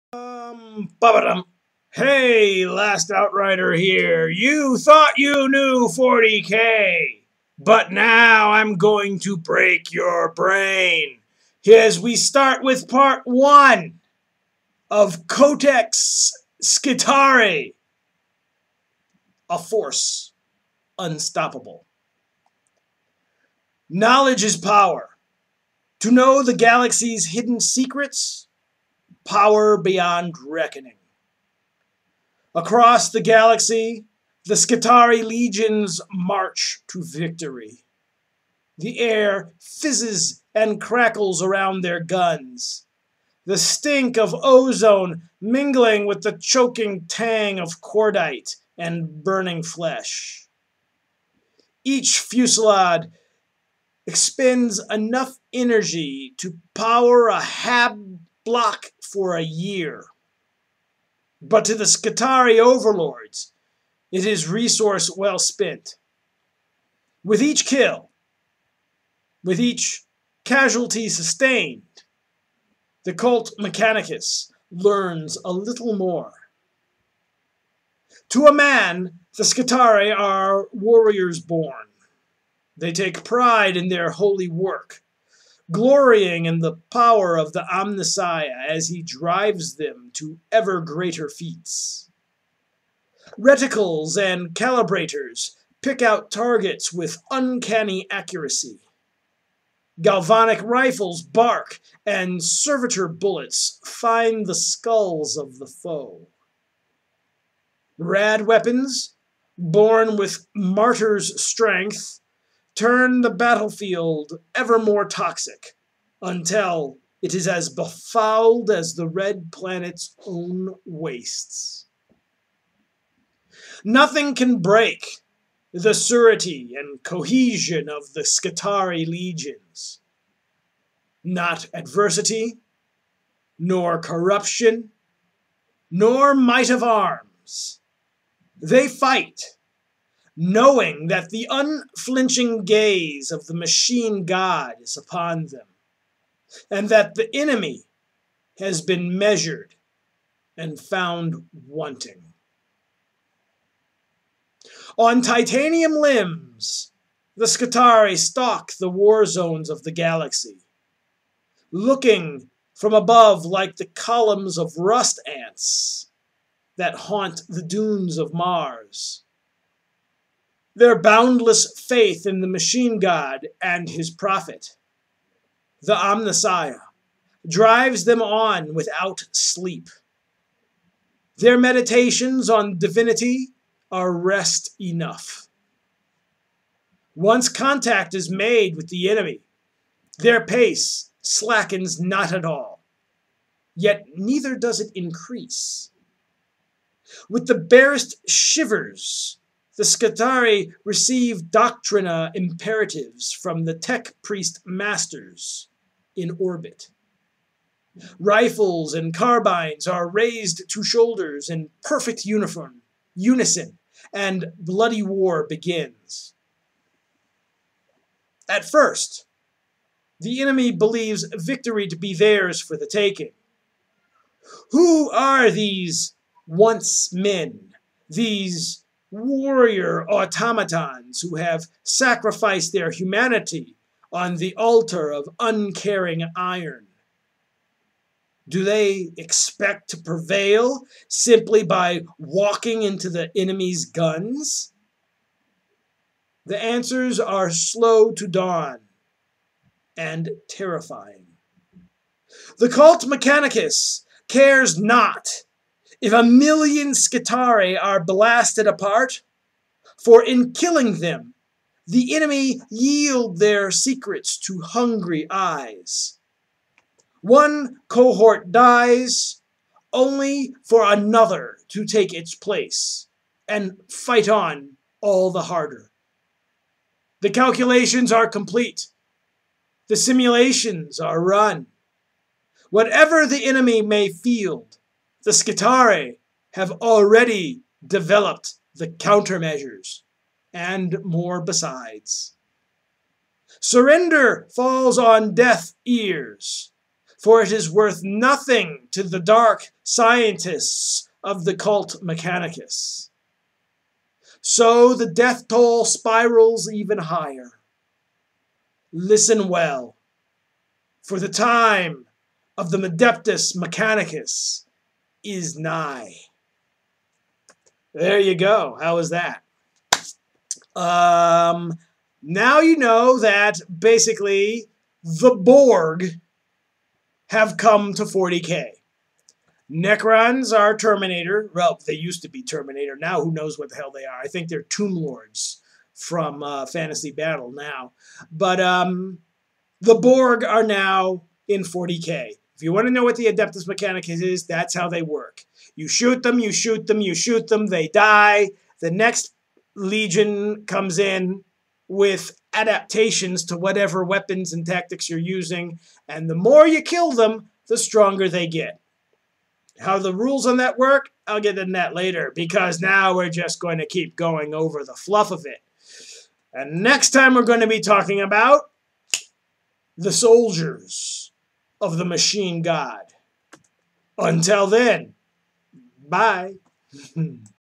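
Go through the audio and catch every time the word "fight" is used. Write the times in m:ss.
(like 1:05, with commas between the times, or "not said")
2:18, 4:33.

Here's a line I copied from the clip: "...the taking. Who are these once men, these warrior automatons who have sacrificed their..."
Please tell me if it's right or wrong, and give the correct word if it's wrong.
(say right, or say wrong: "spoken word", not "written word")
right.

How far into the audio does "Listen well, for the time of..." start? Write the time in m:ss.
5:08.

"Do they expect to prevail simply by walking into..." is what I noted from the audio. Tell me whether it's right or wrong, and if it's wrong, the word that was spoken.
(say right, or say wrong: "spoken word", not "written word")
right.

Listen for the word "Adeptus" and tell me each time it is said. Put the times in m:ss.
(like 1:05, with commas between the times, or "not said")
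5:12, 5:43.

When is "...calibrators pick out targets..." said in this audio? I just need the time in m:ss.
1:34.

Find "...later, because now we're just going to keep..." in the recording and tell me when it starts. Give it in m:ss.
6:01.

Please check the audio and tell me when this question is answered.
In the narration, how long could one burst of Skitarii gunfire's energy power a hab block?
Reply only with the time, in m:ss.
0:59.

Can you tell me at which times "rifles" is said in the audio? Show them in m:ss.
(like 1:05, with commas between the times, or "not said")
1:40, 3:28.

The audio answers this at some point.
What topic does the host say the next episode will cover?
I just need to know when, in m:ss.
6:10.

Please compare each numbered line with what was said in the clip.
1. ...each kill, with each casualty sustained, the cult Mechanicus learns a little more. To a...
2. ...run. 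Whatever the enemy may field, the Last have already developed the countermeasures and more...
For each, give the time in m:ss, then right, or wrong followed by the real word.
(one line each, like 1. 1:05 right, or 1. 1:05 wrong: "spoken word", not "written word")
1. 1:07 right
2. 4:41 wrong: "Skitarii", not "Last".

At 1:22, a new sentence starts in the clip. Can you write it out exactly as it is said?
They take pride in their holy work, glorying in the power of the Omnissiah as he drives them to ever greater feats.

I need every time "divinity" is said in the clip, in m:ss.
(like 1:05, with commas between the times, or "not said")
3:02.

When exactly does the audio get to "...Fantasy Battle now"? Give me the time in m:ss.
5:36.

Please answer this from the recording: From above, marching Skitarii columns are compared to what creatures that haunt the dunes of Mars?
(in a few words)
rust ants.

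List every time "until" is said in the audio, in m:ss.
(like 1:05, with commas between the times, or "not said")
1:56, 6:14.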